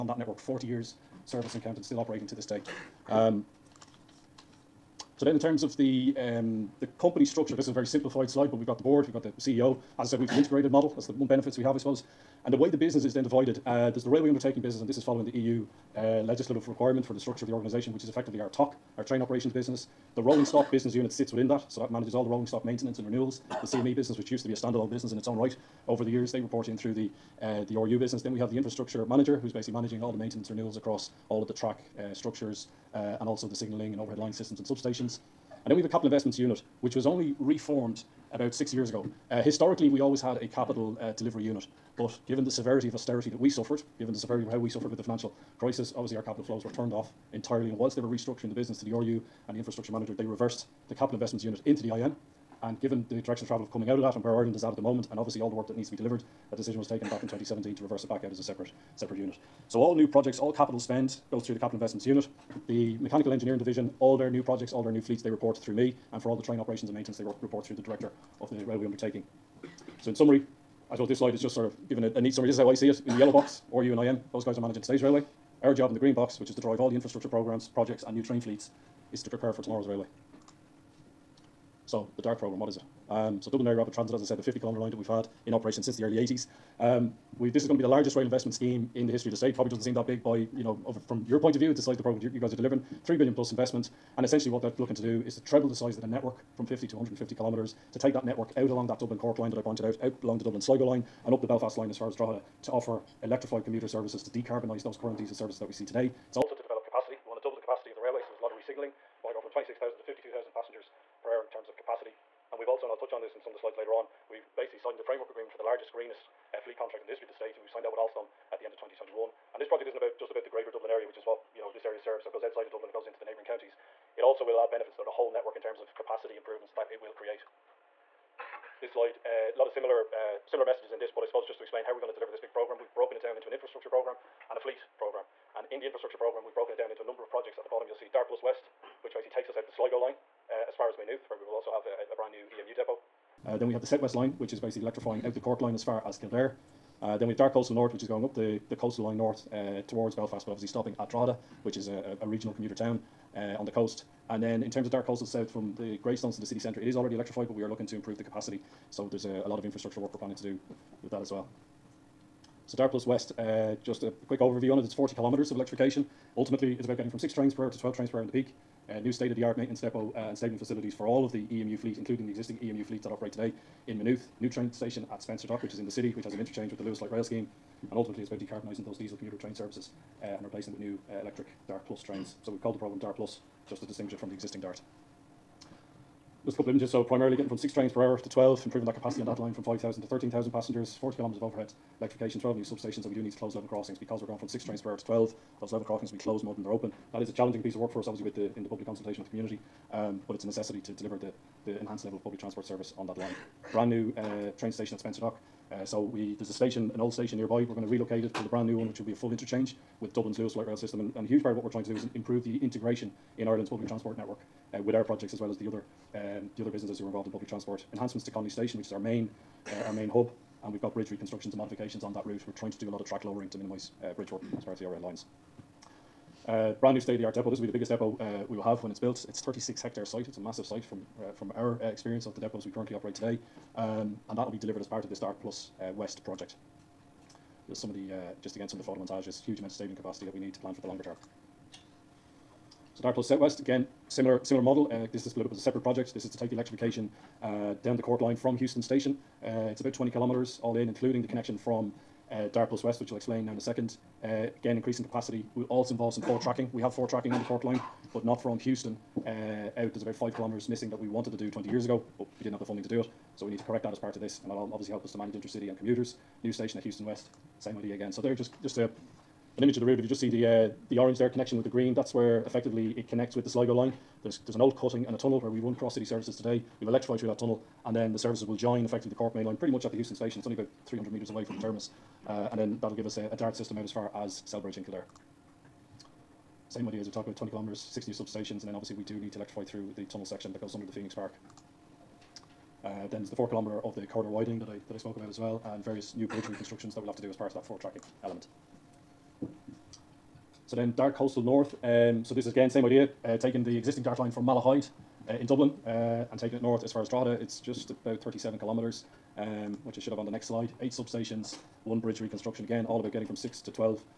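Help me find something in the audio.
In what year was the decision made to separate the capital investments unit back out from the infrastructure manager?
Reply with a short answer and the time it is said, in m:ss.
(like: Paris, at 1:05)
2017, at 0:57.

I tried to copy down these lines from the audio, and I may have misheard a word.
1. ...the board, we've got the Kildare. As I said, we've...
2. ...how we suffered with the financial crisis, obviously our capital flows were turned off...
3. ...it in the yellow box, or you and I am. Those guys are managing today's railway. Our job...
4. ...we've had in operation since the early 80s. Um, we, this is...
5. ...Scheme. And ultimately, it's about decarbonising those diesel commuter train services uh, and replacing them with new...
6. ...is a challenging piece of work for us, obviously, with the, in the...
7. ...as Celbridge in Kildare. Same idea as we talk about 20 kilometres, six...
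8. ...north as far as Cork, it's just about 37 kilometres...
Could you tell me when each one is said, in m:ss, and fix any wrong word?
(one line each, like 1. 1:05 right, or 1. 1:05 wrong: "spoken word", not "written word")
1. 0:08 wrong: "CEO", not "Kildare"
2. 0:44 right
3. 1:12 right
4. 1:24 right
5. 2:57 right
6. 3:17 right
7. 4:44 right
8. 5:06 wrong: "Drogheda", not "Cork".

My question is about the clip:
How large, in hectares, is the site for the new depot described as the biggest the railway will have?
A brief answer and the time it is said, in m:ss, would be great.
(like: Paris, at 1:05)
36 hectares, at 3:49.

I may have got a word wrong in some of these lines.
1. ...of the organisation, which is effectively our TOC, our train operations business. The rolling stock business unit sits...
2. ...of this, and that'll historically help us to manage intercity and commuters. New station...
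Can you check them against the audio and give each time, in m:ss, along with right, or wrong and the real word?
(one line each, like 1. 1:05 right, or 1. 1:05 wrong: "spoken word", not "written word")
1. 0:17 right
2. 4:24 wrong: "obviously", not "historically".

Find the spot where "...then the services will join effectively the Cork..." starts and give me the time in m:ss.
4:37.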